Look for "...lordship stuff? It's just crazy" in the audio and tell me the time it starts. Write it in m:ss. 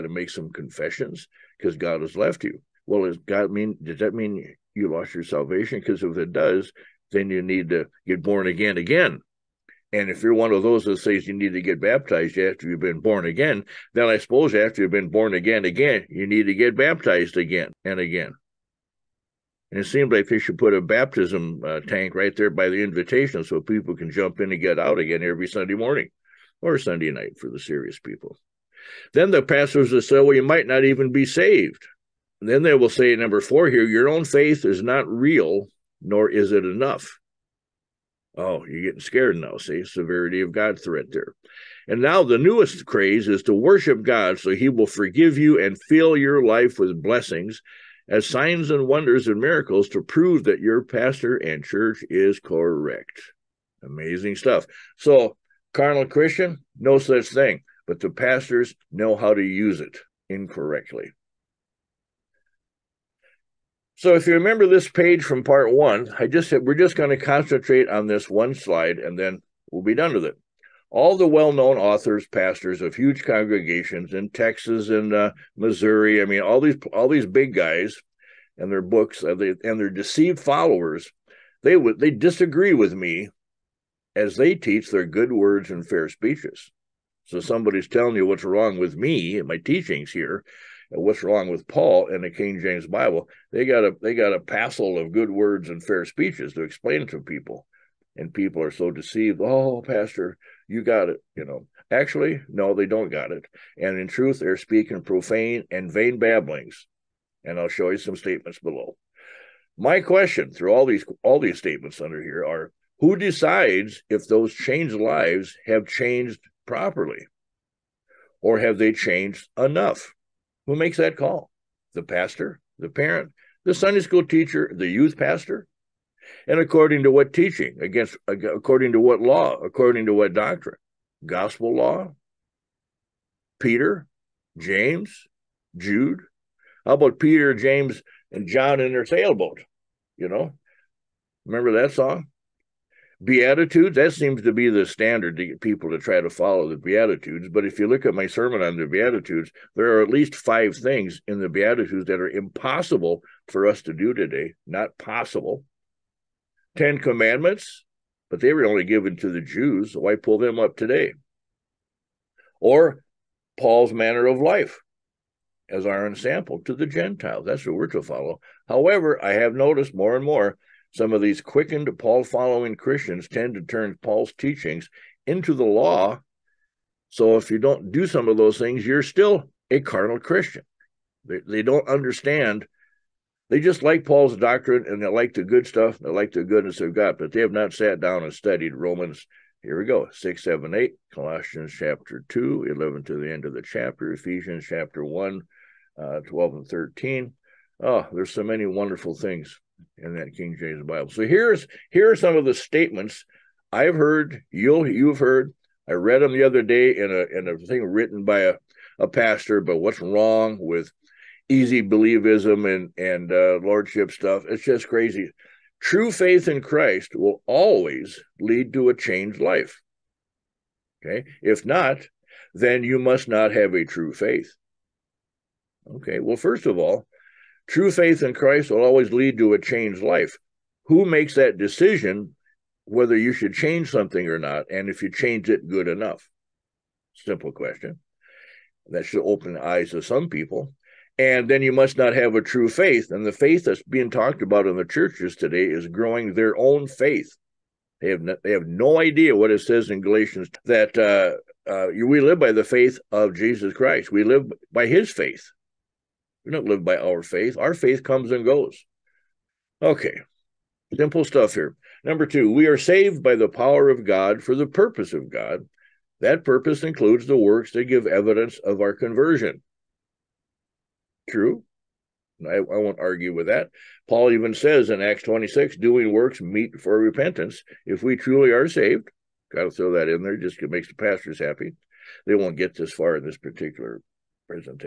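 3:33.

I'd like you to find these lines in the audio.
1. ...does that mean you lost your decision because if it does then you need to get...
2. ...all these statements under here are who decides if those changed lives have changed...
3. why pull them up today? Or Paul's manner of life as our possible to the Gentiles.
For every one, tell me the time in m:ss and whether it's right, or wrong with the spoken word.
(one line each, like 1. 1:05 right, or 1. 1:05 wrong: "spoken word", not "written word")
1. 0:03 wrong: "salvation", not "decision"
2. 1:51 right
3. 2:39 wrong: "ensample", not "possible".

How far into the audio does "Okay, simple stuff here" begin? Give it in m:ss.
4:19.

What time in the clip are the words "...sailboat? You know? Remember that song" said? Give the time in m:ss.
2:19.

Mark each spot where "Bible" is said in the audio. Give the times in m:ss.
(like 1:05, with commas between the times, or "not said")
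1:32, 3:20.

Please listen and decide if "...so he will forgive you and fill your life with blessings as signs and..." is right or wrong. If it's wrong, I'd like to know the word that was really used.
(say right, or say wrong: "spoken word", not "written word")
right.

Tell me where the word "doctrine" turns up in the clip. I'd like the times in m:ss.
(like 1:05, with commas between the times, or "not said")
2:10, 3:04.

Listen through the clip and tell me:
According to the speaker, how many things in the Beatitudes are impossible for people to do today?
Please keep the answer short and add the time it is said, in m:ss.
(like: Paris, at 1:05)
5, at 2:30.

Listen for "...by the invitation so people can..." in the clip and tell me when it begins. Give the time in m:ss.
0:22.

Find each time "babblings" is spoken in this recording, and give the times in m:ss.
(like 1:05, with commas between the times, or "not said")
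1:46.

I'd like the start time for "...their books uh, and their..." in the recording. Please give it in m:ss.
1:18.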